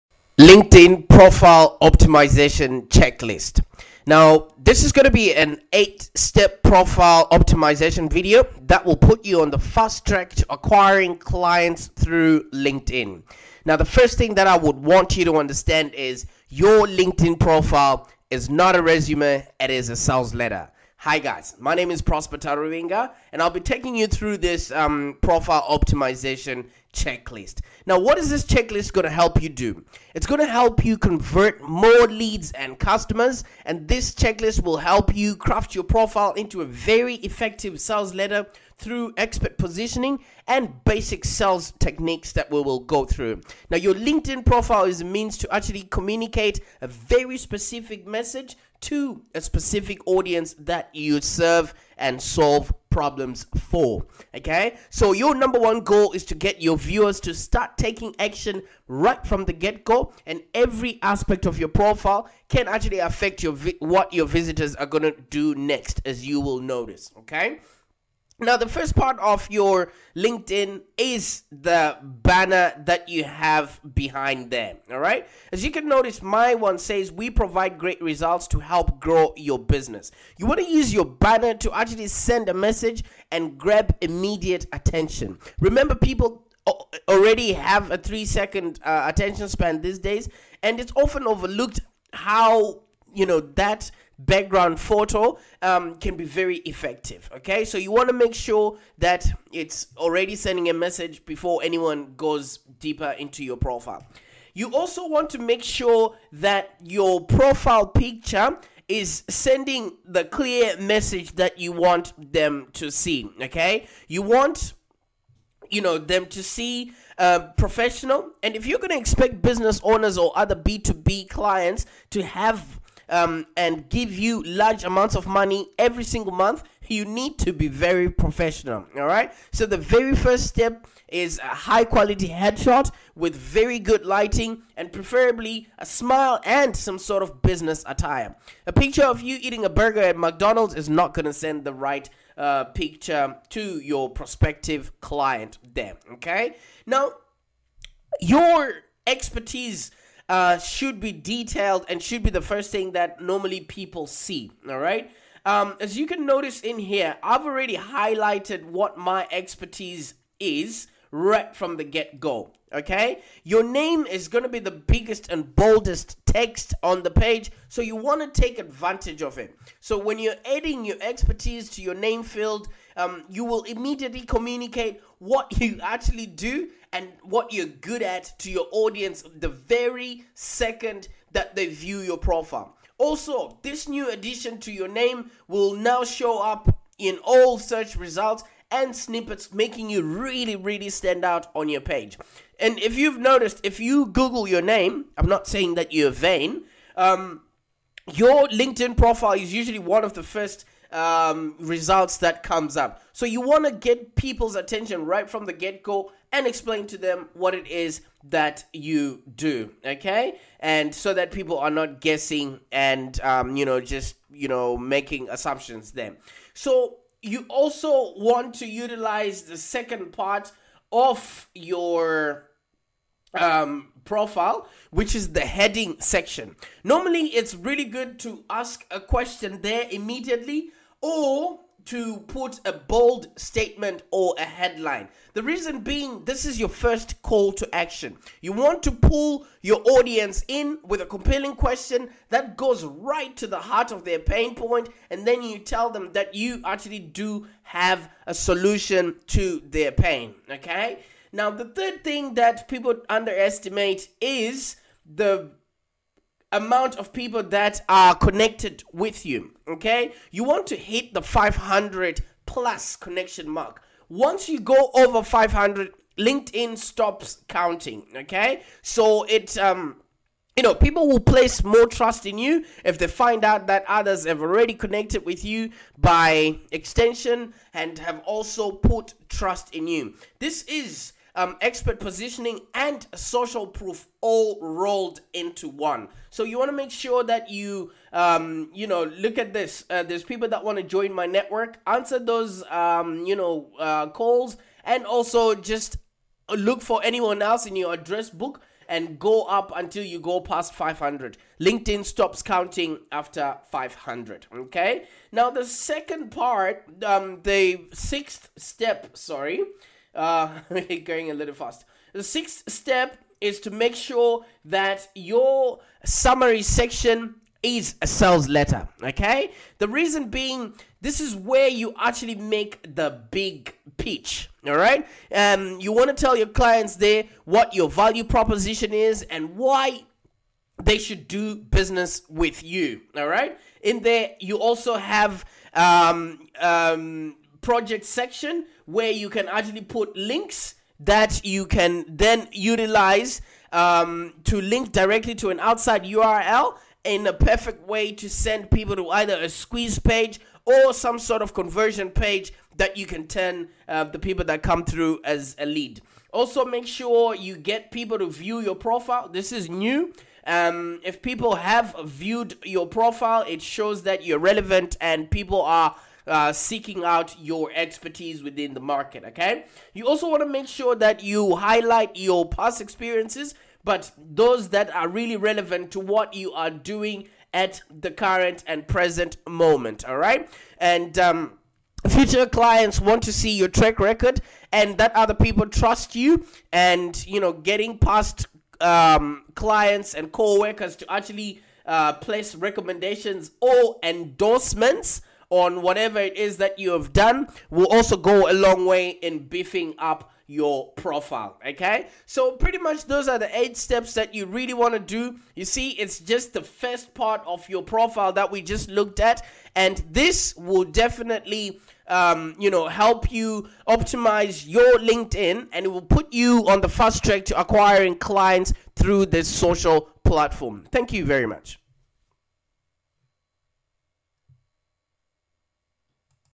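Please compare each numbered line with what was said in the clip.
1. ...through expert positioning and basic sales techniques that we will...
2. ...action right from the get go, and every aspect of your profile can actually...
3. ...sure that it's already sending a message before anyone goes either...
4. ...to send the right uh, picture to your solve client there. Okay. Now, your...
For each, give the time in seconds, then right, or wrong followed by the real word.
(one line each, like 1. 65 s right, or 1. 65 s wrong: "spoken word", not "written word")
1. 38 s right
2. 58 s right
3. 98 s wrong: "deeper", not "either"
4. 141 s wrong: "prospective", not "solve".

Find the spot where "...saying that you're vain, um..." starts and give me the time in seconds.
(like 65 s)
195 s.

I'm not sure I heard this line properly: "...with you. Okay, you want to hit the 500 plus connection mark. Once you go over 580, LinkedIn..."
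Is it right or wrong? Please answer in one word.
wrong.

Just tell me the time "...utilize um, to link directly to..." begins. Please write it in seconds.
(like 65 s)
342 s.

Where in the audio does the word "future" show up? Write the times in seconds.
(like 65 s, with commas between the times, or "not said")
382 s.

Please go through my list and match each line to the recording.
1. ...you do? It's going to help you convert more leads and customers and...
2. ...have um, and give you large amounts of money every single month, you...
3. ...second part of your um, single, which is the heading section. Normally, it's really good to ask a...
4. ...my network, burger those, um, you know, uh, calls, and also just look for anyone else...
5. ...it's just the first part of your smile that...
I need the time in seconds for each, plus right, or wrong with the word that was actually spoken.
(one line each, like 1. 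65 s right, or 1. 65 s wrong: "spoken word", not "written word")
1. 29 s right
2. 122 s right
3. 219 s wrong: "profile", not "single"
4. 291 s wrong: "answer", not "burger"
5. 405 s wrong: "profile", not "smile".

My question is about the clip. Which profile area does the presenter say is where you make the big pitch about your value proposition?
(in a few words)
Summary section.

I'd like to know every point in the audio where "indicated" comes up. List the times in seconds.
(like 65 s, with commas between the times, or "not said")
not said.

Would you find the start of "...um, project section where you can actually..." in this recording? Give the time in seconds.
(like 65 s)
336 s.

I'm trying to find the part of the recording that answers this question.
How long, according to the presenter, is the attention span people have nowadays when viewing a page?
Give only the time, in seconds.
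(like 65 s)
87 s.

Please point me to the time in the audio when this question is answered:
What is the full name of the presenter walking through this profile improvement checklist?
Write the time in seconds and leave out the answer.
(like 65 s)
21 s.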